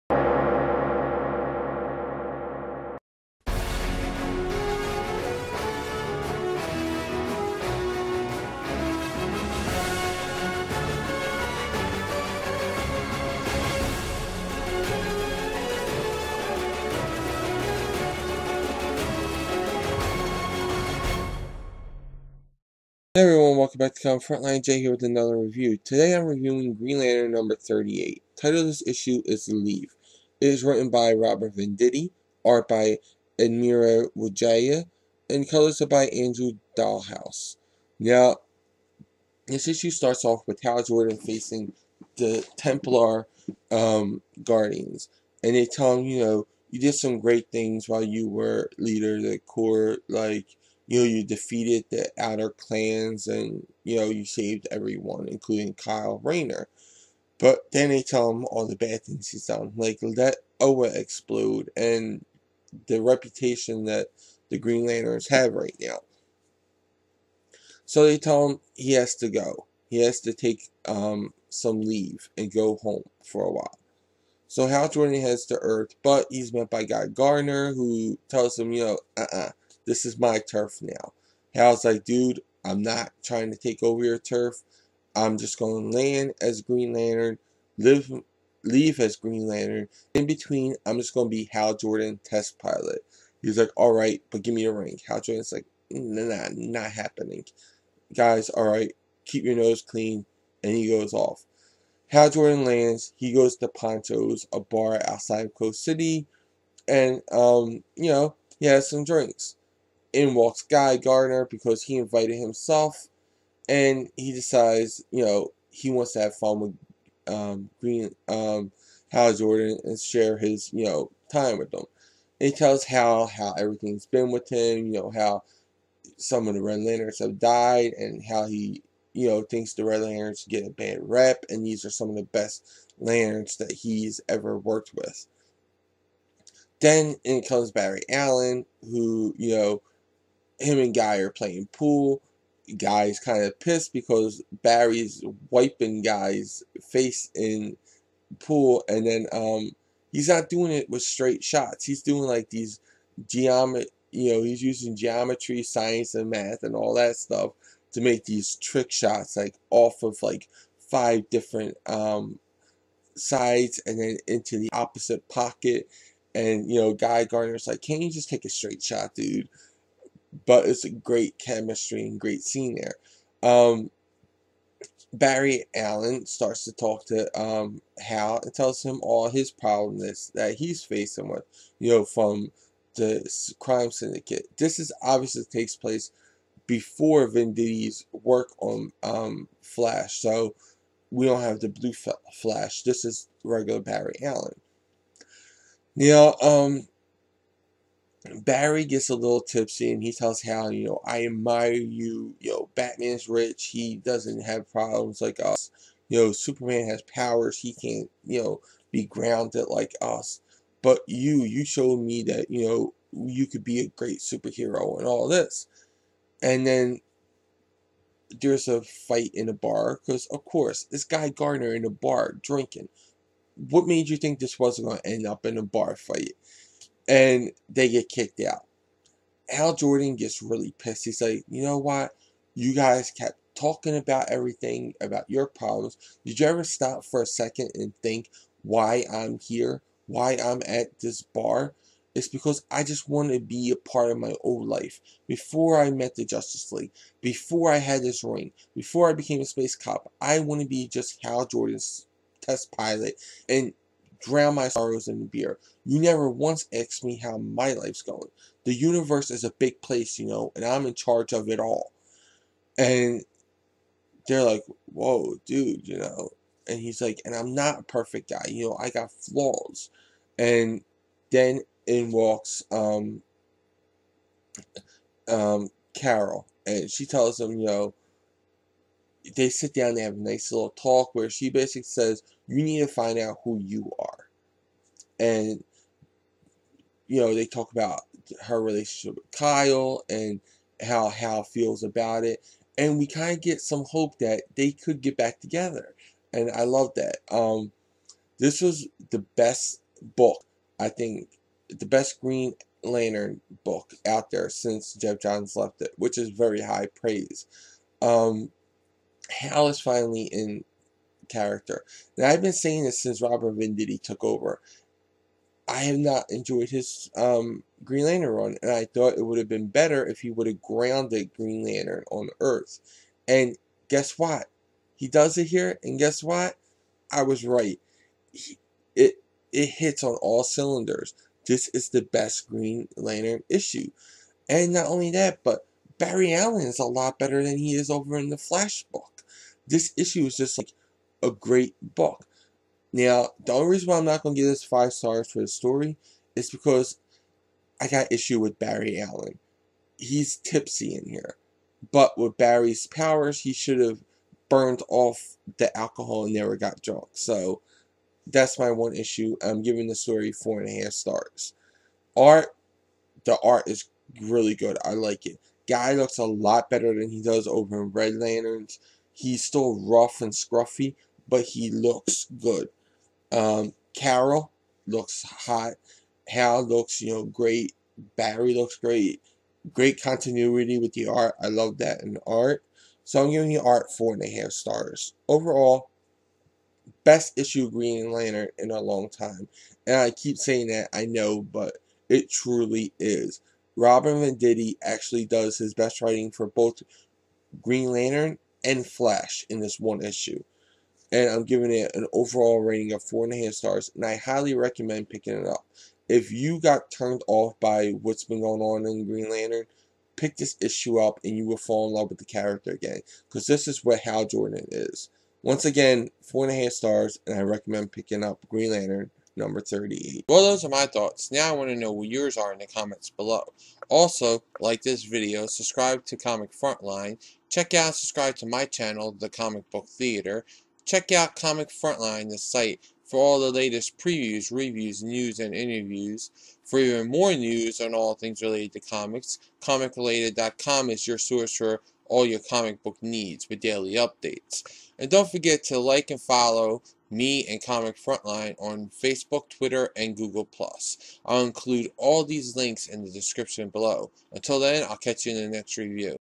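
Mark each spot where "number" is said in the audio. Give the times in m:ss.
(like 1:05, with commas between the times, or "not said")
0:27, 6:59.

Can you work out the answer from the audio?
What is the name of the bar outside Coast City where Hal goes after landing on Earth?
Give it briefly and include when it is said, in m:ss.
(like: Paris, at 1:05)
Poncho's, at 1:43.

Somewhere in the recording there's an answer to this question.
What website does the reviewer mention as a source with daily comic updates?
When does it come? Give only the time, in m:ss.
7:19.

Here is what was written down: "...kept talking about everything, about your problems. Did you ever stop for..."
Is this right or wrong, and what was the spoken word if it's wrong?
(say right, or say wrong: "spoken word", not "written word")
right.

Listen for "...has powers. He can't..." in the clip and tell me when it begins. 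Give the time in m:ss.
3:26.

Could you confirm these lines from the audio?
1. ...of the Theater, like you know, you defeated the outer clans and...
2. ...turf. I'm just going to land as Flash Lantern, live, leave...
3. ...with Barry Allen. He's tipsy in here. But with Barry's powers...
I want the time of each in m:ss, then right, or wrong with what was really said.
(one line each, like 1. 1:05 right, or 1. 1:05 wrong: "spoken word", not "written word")
1. 0:49 wrong: "Corps", not "Theater"
2. 1:24 wrong: "Green", not "Flash"
3. 5:48 right.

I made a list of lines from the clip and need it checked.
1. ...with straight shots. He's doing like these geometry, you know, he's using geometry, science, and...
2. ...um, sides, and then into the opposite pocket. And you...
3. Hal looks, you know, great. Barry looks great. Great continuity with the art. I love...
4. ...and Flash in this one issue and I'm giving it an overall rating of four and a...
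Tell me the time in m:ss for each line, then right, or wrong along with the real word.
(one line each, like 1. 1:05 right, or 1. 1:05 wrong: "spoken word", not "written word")
1. 2:30 right
2. 2:41 right
3. 6:16 right
4. 6:38 right.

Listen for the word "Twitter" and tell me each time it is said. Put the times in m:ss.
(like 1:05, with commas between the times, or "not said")
7:29.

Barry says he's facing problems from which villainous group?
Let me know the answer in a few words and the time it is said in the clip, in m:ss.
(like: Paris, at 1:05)
The crime syndicate, at 3:03.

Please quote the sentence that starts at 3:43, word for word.
What made you think this wasn't going to end up in a bar fight?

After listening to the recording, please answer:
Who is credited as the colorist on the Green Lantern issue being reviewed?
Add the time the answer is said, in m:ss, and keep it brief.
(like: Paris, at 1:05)
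Andrew Dalhouse, at 0:36.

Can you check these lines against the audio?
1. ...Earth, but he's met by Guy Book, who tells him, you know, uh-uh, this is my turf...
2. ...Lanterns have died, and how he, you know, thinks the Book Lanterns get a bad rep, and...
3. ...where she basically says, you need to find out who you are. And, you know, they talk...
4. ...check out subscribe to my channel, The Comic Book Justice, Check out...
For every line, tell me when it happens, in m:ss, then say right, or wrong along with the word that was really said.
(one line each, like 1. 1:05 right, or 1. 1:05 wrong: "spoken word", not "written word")
1. 1:15 wrong: "Gardner", not "Book"
2. 2:06 wrong: "Red", not "Book"
3. 4:41 right
4. 7:07 wrong: "Theater", not "Justice".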